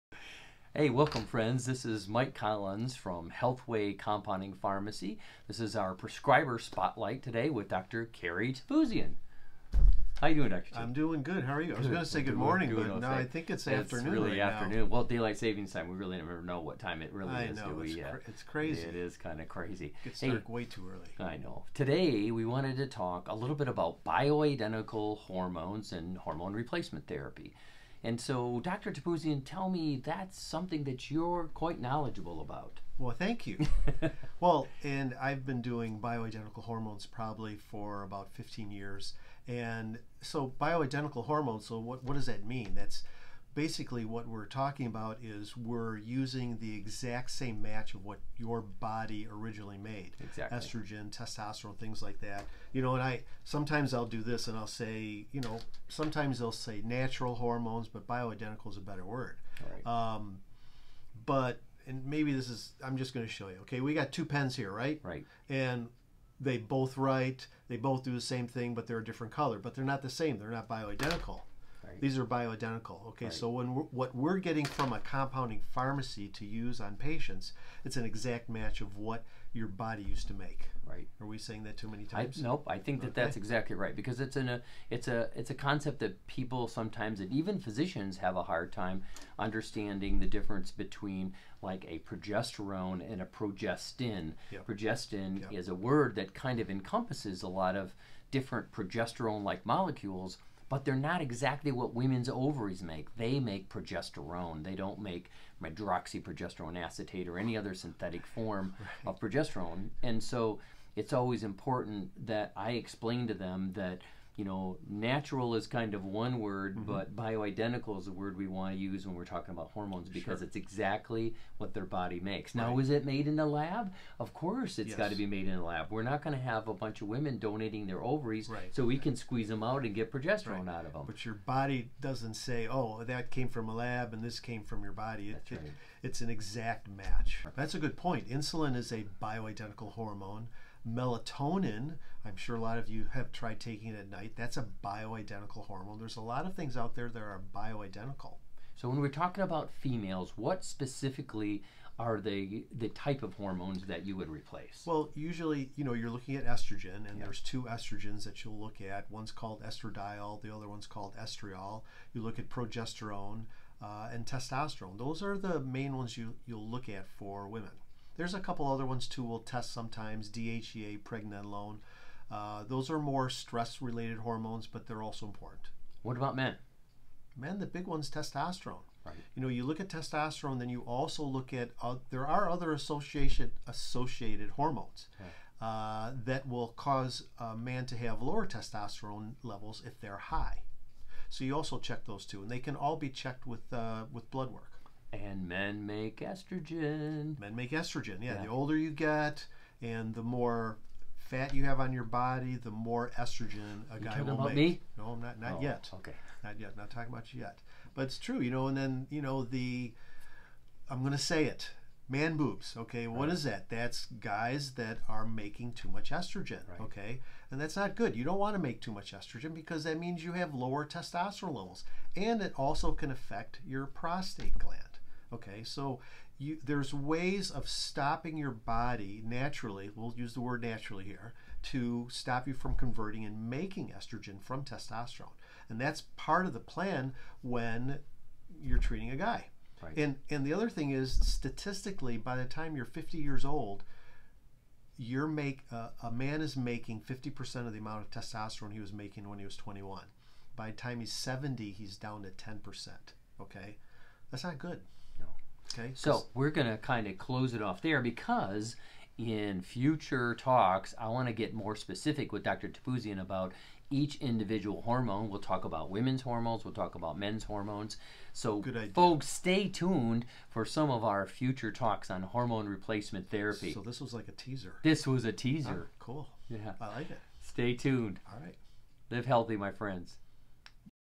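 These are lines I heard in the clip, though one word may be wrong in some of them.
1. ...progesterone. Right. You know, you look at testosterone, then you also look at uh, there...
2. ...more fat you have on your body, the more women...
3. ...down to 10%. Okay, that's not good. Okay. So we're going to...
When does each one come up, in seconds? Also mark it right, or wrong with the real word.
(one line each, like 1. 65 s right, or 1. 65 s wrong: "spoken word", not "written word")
1. 178 s wrong: "testosterone", not "progesterone"
2. 200 s wrong: "estrogen", not "women"
3. 251 s right.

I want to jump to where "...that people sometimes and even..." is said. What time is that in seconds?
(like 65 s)
85 s.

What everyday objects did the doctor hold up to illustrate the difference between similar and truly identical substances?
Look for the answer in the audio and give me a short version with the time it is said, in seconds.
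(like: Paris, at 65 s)
Two pens, at 64 s.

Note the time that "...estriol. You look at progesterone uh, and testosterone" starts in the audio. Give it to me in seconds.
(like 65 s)
161 s.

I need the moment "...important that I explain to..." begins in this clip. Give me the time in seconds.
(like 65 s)
111 s.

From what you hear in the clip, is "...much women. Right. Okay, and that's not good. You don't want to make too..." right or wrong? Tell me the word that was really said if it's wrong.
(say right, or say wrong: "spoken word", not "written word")
wrong: "estrogen", not "women".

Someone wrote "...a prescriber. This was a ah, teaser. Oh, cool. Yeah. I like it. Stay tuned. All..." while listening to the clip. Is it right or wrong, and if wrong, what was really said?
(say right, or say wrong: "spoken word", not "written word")
wrong: "teaser", not "prescriber".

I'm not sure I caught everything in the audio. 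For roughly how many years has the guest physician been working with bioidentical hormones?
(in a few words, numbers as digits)
15 years.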